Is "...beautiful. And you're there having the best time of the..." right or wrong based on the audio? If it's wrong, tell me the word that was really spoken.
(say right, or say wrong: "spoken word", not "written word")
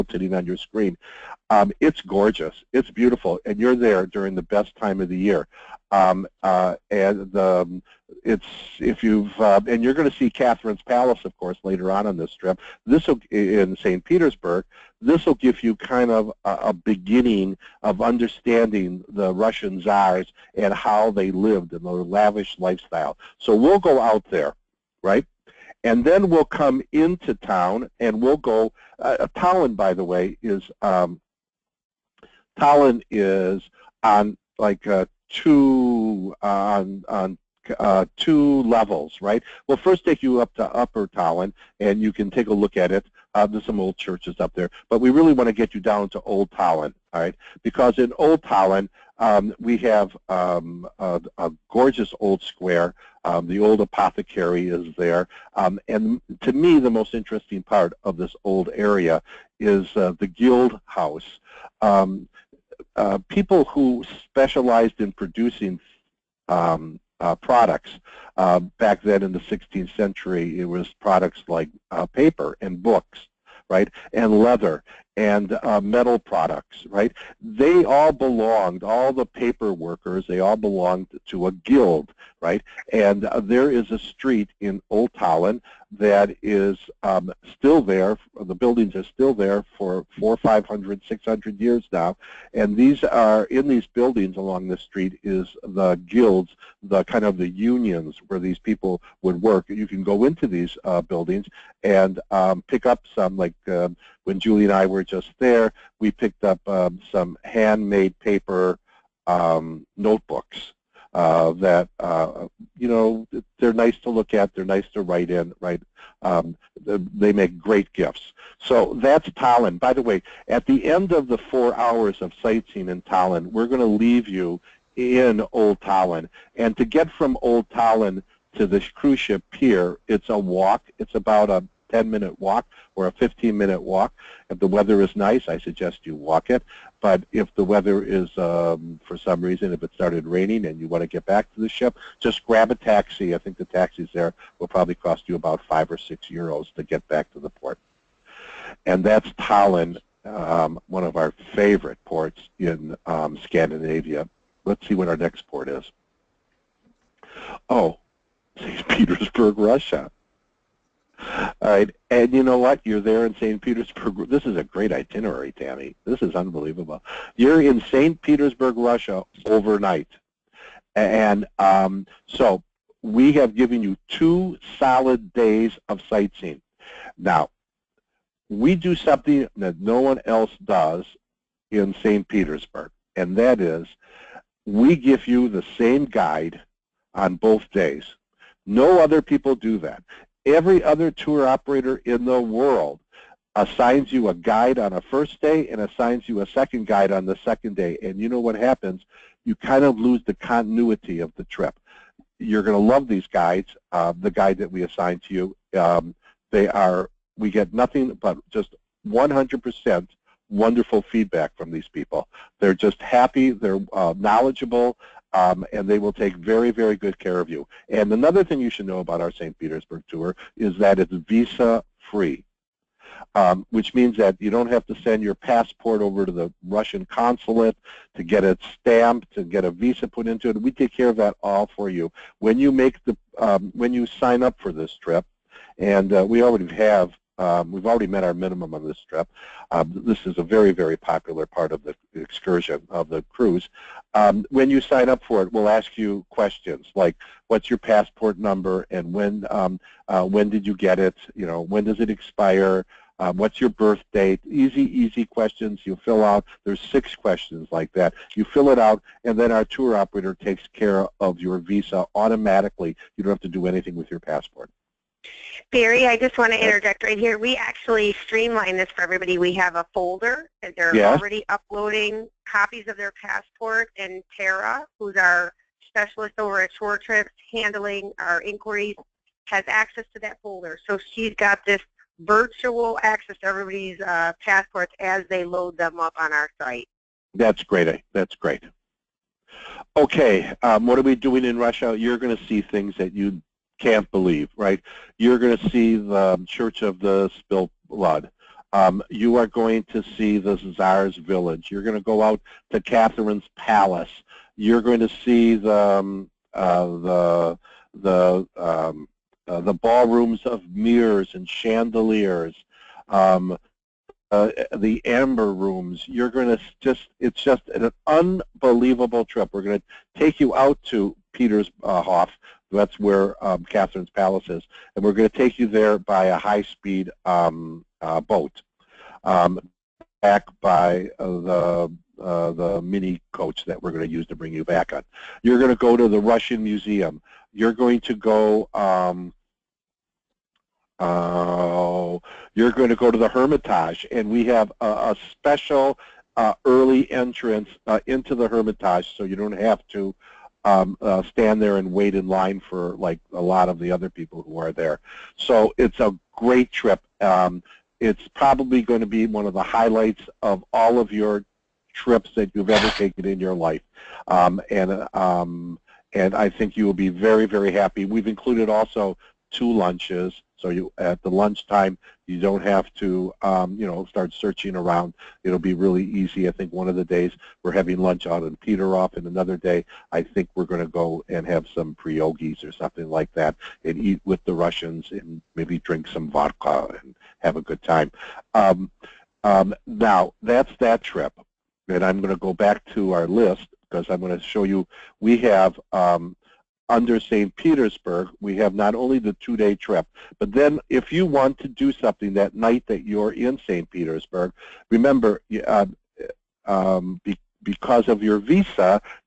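wrong: "during", not "having".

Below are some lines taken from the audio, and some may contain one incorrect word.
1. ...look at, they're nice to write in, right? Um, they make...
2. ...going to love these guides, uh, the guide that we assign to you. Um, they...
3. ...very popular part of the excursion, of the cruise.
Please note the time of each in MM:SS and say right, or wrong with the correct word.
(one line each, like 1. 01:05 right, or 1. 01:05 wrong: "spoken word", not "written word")
1. 01:54 right
2. 03:22 right
3. 04:00 right.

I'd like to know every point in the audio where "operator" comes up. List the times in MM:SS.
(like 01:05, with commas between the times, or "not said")
03:11, 04:19.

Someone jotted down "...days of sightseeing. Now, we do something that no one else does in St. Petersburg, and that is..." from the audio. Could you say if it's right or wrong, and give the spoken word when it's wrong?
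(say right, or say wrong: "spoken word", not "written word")
right.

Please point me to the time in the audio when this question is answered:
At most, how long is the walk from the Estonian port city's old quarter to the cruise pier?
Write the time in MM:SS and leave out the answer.
02:13.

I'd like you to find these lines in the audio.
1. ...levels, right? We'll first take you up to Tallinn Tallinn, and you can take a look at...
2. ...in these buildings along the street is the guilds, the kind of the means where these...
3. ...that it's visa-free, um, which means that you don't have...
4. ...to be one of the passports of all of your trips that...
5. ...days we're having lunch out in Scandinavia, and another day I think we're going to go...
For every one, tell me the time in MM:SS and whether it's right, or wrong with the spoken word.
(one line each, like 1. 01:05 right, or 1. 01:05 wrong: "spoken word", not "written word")
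1. 00:38 wrong: "Upper", not "Tallinn"
2. 01:33 wrong: "unions", not "means"
3. 03:40 right
4. 05:59 wrong: "highlights", not "passports"
5. 06:17 wrong: "Peteroff", not "Scandinavia".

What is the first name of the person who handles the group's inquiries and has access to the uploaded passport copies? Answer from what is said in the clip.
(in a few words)
Tara.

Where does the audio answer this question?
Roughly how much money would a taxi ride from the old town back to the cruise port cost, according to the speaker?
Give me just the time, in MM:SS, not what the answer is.
02:25.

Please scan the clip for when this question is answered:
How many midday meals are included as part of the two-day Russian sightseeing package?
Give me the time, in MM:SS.
06:09.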